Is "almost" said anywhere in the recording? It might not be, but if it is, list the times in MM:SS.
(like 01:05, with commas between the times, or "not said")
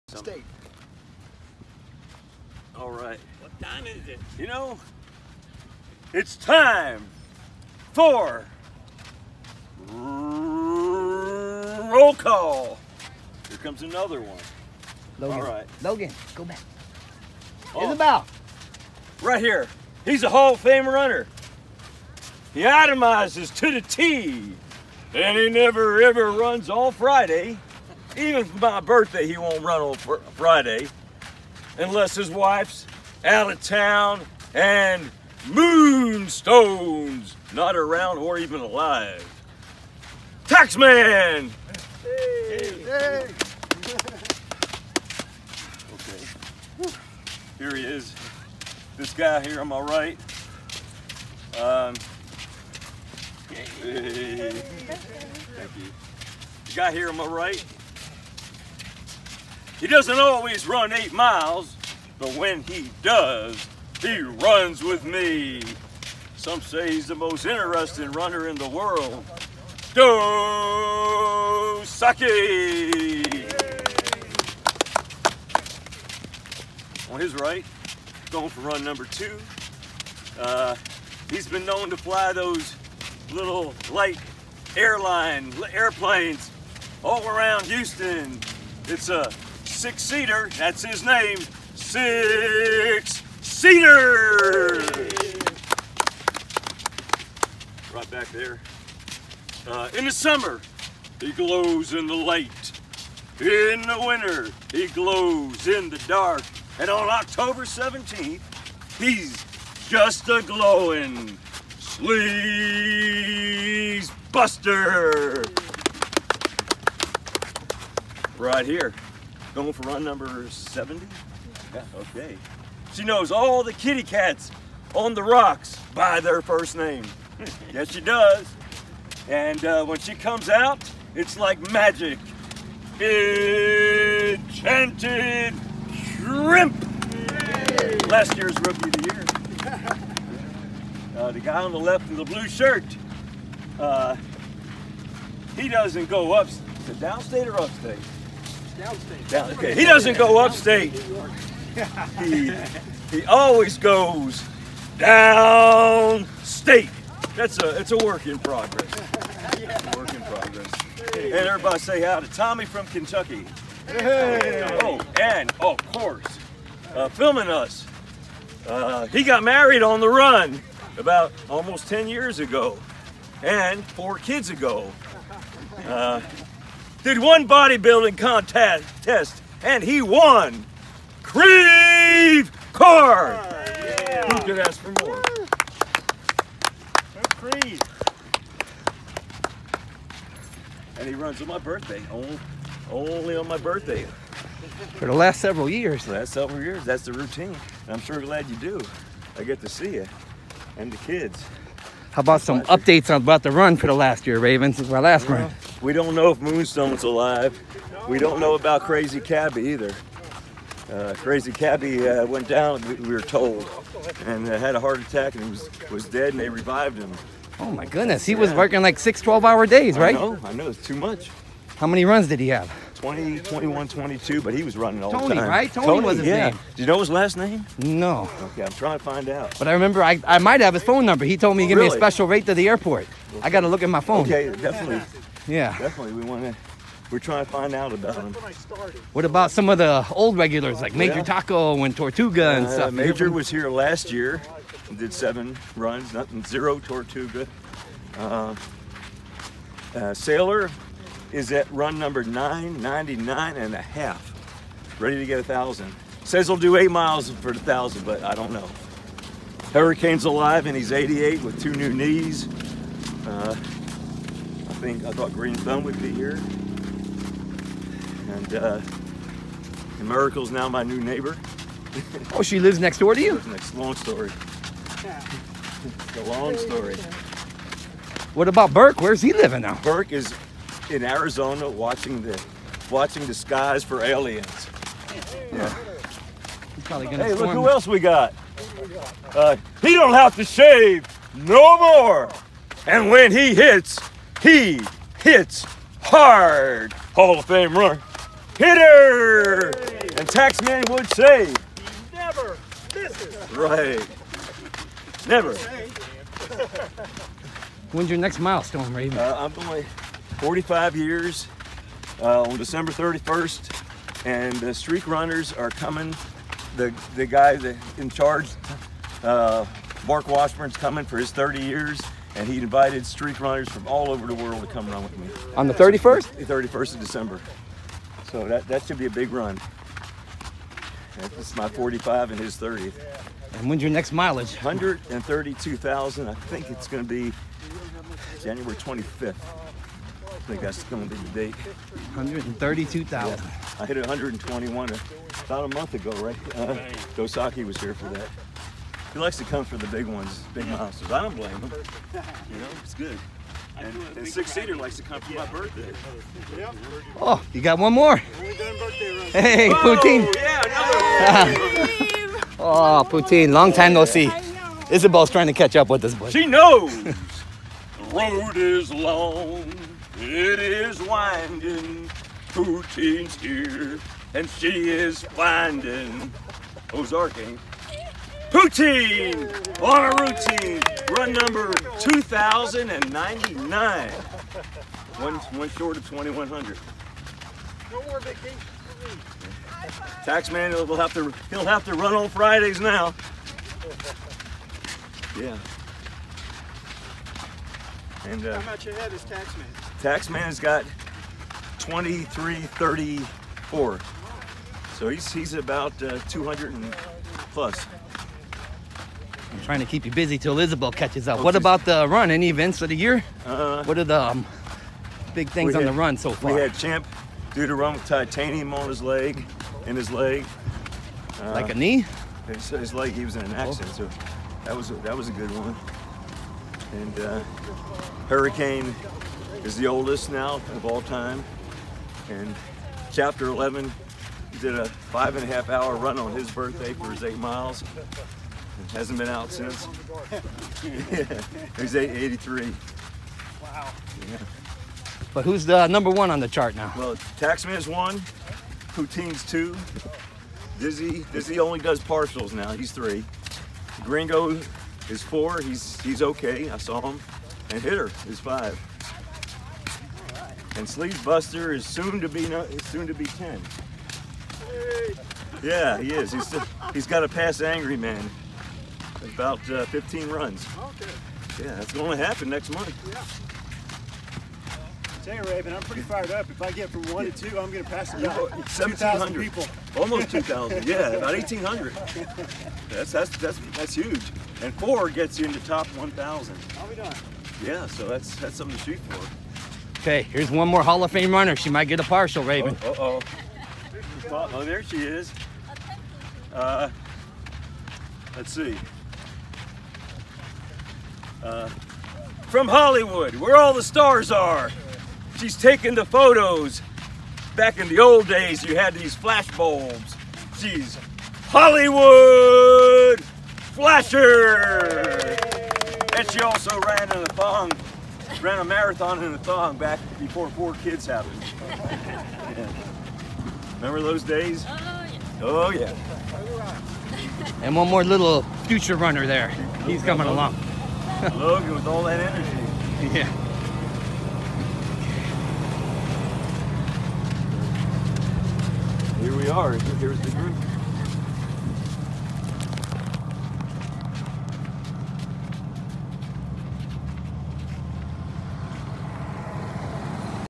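02:51, 07:59.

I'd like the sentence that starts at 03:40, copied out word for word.
I know, I know, it's too much.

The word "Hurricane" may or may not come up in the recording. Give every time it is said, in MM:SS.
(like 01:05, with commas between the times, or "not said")
04:19, 07:08.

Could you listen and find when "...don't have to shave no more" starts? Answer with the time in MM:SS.
04:49.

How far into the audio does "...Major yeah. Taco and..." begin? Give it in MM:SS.
04:00.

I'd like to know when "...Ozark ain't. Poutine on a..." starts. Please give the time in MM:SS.
06:16.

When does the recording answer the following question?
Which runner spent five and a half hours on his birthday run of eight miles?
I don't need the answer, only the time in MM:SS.
07:13.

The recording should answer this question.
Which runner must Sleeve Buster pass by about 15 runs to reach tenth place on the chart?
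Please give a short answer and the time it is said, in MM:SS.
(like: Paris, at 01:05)
Angry Man, at 07:47.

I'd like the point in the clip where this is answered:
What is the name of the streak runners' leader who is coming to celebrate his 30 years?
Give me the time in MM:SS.
05:20.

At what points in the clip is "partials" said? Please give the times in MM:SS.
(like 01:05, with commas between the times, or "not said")
07:32, 08:12.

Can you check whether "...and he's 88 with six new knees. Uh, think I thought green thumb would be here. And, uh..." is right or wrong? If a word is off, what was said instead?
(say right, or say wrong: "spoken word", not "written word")
wrong: "two", not "six".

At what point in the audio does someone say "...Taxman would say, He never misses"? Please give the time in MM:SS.
05:00.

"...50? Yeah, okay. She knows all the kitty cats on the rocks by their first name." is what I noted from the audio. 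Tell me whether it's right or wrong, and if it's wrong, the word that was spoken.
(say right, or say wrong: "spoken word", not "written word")
wrong: "70", not "50".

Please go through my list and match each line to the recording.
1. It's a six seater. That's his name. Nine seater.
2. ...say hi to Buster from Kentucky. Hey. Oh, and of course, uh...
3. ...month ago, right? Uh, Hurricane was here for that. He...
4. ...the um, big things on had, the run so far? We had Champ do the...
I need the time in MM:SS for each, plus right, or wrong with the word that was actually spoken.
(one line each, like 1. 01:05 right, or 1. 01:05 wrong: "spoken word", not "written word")
1. 01:28 wrong: "Six", not "Nine"
2. 02:41 wrong: "Tommy", not "Buster"
3. 05:45 wrong: "Dosaki", not "Hurricane"
4. 06:54 right.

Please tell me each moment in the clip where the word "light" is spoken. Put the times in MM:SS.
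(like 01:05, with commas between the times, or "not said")
01:23, 01:42.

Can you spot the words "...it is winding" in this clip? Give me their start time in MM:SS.
06:10.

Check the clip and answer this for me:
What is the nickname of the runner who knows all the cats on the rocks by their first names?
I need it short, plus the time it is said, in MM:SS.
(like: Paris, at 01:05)
Enchanted Shrimp, at 02:12.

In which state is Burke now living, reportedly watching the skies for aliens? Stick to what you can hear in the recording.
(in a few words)
Arizona.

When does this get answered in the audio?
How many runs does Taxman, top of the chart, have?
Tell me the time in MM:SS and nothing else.
06:41.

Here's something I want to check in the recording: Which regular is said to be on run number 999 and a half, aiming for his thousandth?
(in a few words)
Sailor.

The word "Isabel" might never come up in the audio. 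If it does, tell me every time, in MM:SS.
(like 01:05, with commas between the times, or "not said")
00:17, 06:04, 06:50.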